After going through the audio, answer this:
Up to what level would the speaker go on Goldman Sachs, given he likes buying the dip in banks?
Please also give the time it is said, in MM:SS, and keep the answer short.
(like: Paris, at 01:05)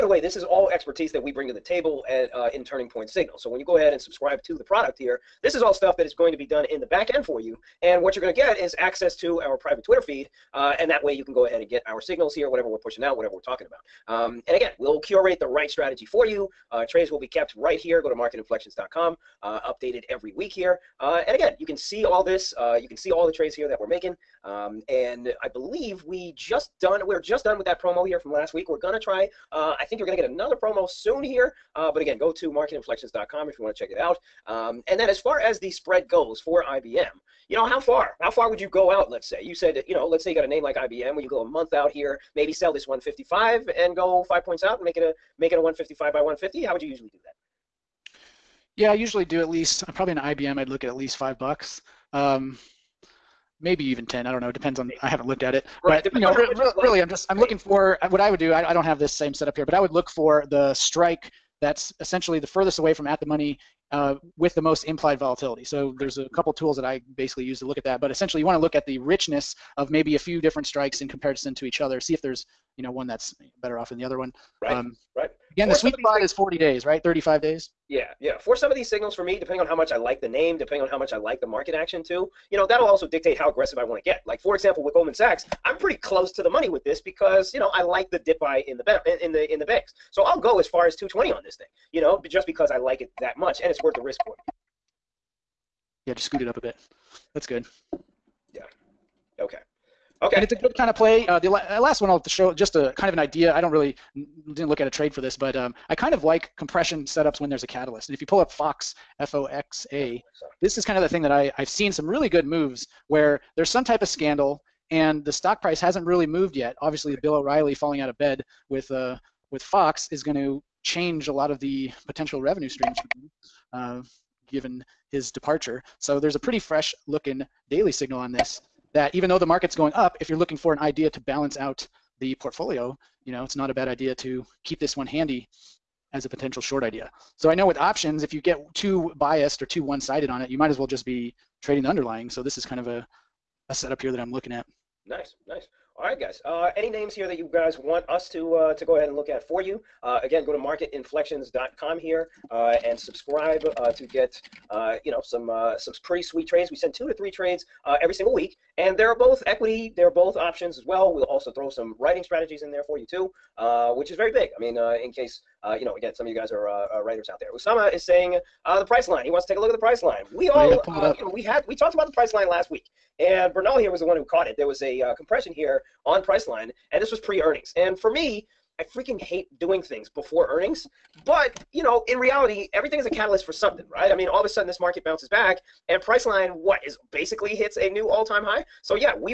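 220, at 01:30.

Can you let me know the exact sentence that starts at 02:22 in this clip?
So this is kind of a, a setup here that I'm looking at.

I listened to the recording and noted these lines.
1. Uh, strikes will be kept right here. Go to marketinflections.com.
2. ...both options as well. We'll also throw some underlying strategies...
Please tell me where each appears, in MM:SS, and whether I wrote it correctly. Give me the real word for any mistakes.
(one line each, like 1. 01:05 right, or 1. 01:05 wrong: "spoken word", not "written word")
1. 00:16 wrong: "trades", not "strikes"
2. 02:40 wrong: "writing", not "underlying".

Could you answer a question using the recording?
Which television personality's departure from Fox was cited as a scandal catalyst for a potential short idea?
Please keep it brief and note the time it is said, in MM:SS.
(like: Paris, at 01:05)
Bill O'Reilly, at 01:57.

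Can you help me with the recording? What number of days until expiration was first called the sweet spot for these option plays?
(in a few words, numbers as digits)
40 days.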